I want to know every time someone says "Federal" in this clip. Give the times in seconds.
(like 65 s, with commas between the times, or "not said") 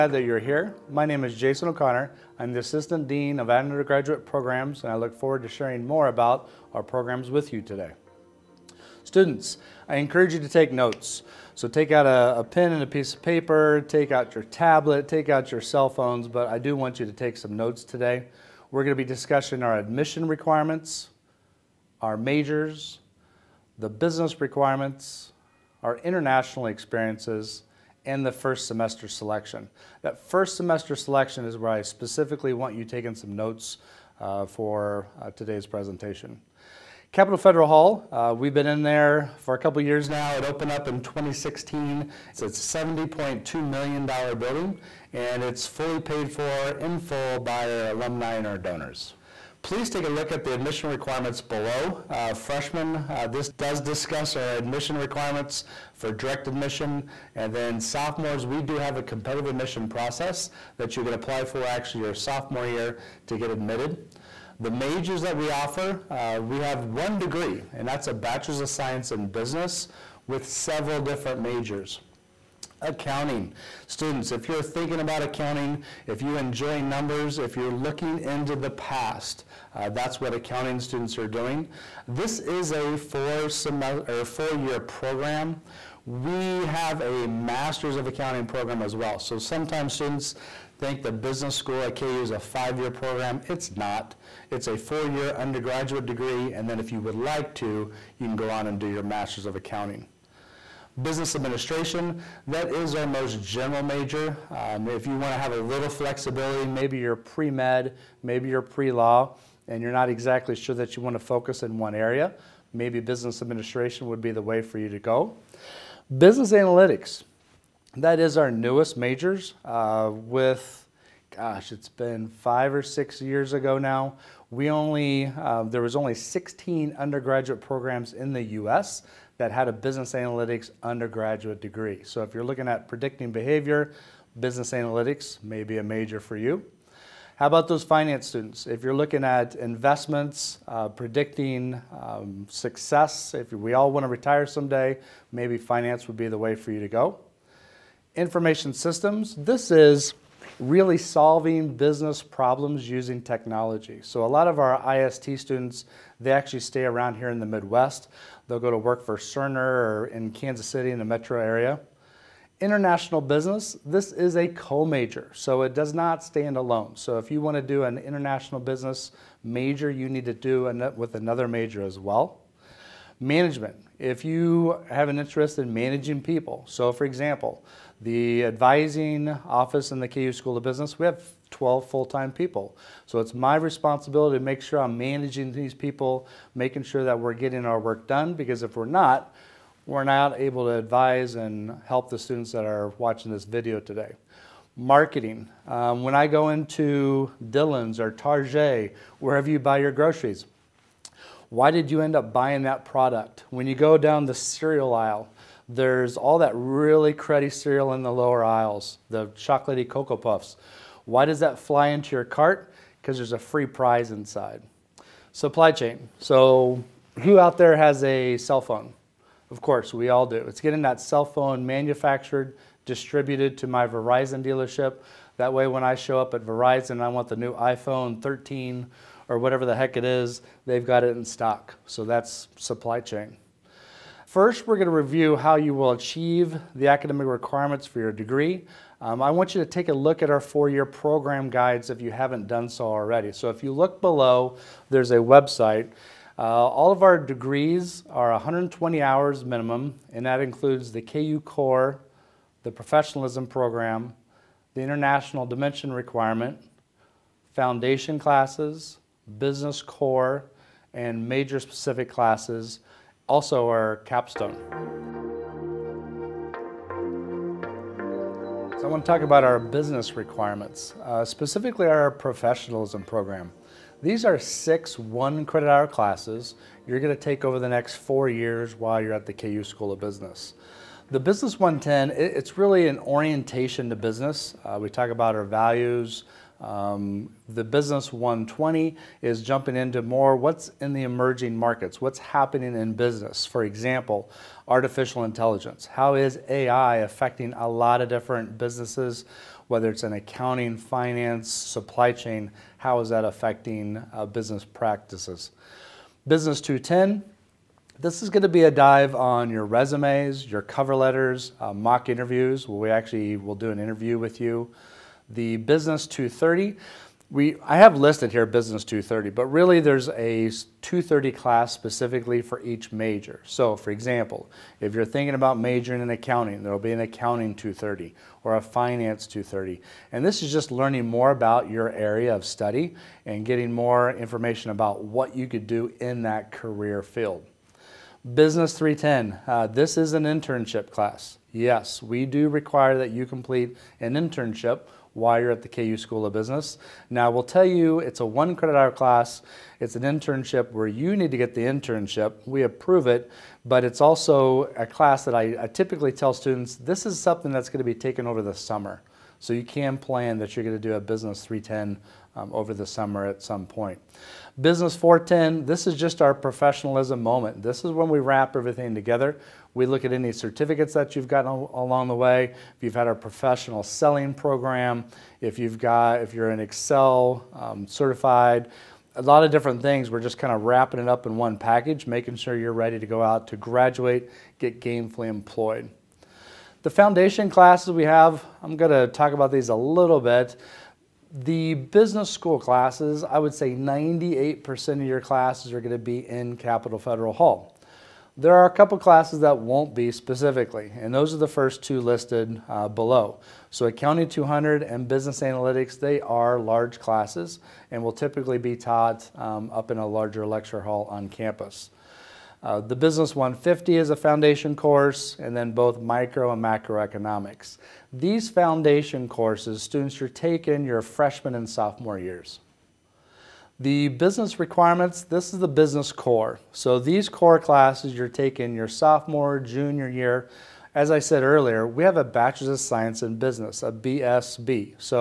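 37 s, 396 s.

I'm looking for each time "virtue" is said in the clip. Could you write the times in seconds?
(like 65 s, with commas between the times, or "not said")
not said.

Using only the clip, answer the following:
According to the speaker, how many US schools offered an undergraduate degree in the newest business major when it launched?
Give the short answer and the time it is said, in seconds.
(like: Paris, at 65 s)
16, at 126 s.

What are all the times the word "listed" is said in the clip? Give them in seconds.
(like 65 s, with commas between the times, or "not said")
317 s, 401 s.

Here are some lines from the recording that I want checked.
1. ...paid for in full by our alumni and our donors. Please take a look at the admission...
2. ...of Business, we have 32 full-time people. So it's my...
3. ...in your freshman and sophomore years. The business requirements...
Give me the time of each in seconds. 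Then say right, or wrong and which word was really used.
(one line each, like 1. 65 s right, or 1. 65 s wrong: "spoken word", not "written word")
1. 45 s right
2. 180 s wrong: "12", not "32"
3. 420 s right.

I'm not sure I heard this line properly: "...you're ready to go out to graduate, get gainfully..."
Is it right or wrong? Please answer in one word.
right.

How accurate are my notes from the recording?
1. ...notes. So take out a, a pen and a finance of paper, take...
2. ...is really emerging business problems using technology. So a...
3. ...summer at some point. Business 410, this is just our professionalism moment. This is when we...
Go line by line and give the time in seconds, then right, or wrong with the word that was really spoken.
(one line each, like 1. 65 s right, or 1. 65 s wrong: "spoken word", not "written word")
1. 10 s wrong: "piece", not "finance"
2. 149 s wrong: "solving", not "emerging"
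3. 362 s right.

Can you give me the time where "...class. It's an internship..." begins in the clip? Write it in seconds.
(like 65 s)
348 s.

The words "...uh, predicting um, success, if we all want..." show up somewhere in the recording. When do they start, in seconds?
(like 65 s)
140 s.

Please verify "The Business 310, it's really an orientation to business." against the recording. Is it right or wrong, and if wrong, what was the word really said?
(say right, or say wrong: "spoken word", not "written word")
wrong: "110", not "310".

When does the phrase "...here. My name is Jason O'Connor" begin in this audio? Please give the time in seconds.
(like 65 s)
0 s.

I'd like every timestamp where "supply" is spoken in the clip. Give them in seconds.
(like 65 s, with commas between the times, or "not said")
215 s, 232 s, 301 s.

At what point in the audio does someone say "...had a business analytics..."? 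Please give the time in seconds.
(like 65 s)
129 s.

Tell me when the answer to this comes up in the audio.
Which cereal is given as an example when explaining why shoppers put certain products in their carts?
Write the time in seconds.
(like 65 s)
209 s.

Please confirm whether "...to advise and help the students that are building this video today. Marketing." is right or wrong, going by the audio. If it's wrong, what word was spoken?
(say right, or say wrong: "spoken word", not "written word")
wrong: "watching", not "building".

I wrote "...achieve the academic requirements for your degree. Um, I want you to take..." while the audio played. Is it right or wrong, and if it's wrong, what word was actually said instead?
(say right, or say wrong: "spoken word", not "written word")
right.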